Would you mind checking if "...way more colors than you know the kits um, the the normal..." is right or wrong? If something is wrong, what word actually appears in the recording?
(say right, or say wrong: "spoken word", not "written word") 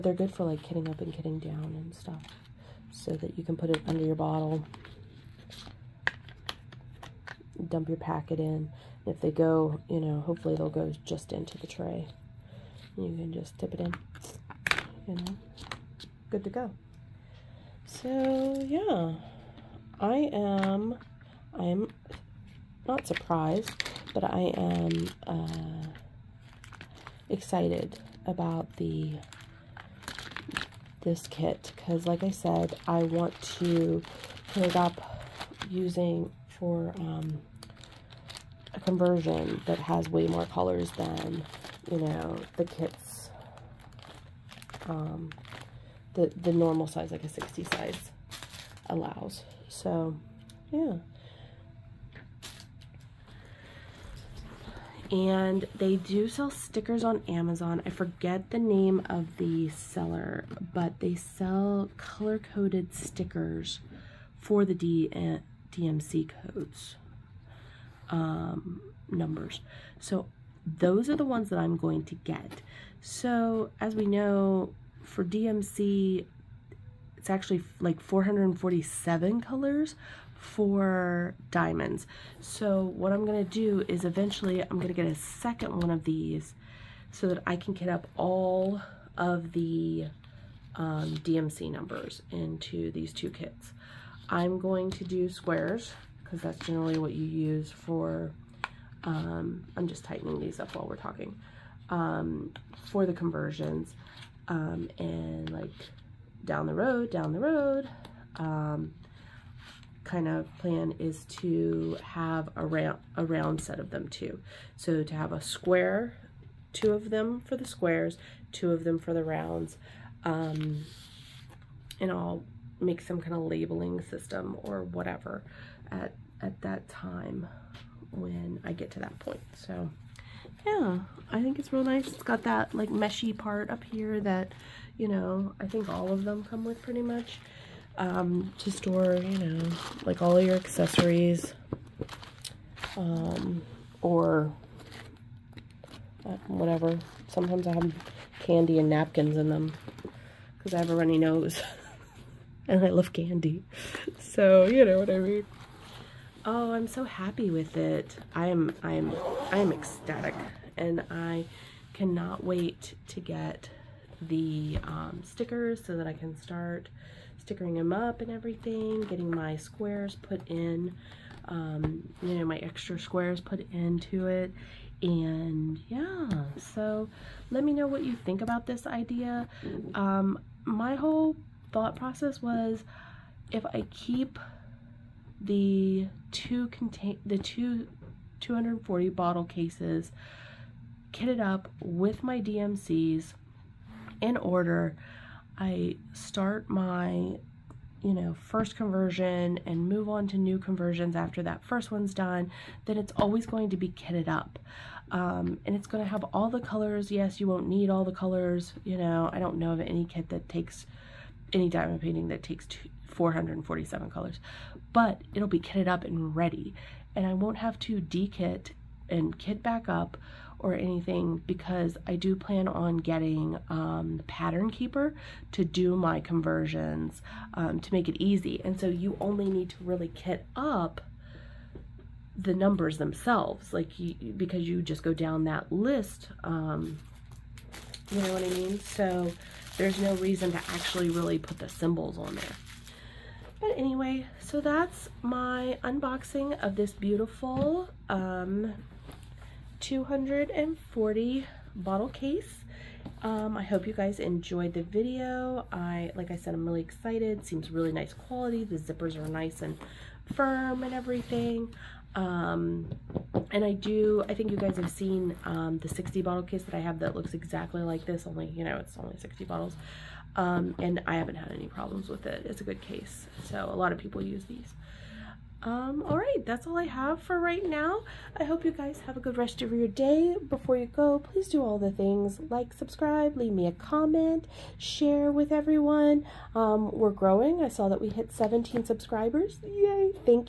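right.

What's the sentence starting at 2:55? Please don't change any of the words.
And yeah, so let me know what you think about this idea.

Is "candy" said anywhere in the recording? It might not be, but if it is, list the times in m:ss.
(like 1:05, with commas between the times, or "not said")
2:28, 2:33.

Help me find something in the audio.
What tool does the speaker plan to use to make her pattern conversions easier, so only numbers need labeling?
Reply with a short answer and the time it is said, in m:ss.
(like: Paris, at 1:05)
pattern keeper, at 3:44.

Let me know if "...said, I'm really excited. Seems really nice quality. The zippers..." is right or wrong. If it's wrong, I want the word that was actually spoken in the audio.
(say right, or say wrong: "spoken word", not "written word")
right.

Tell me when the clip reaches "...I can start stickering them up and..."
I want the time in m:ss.
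2:46.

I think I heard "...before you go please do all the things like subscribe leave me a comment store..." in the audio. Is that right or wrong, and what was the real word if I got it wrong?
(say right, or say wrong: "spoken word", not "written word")
wrong: "share", not "store".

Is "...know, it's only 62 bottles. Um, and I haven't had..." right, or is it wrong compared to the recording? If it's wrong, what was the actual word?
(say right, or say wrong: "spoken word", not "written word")
wrong: "60", not "62".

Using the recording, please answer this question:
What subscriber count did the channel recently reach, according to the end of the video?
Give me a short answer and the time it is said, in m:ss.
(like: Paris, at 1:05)
17, at 4:48.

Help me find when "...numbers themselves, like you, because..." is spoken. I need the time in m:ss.
3:52.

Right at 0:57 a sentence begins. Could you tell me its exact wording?
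I forget the name of the seller, but they sell color-coded stickers for the D uh, DMC codes um, numbers.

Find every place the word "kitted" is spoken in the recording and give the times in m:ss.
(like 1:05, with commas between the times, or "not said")
3:11, 3:23, 3:35.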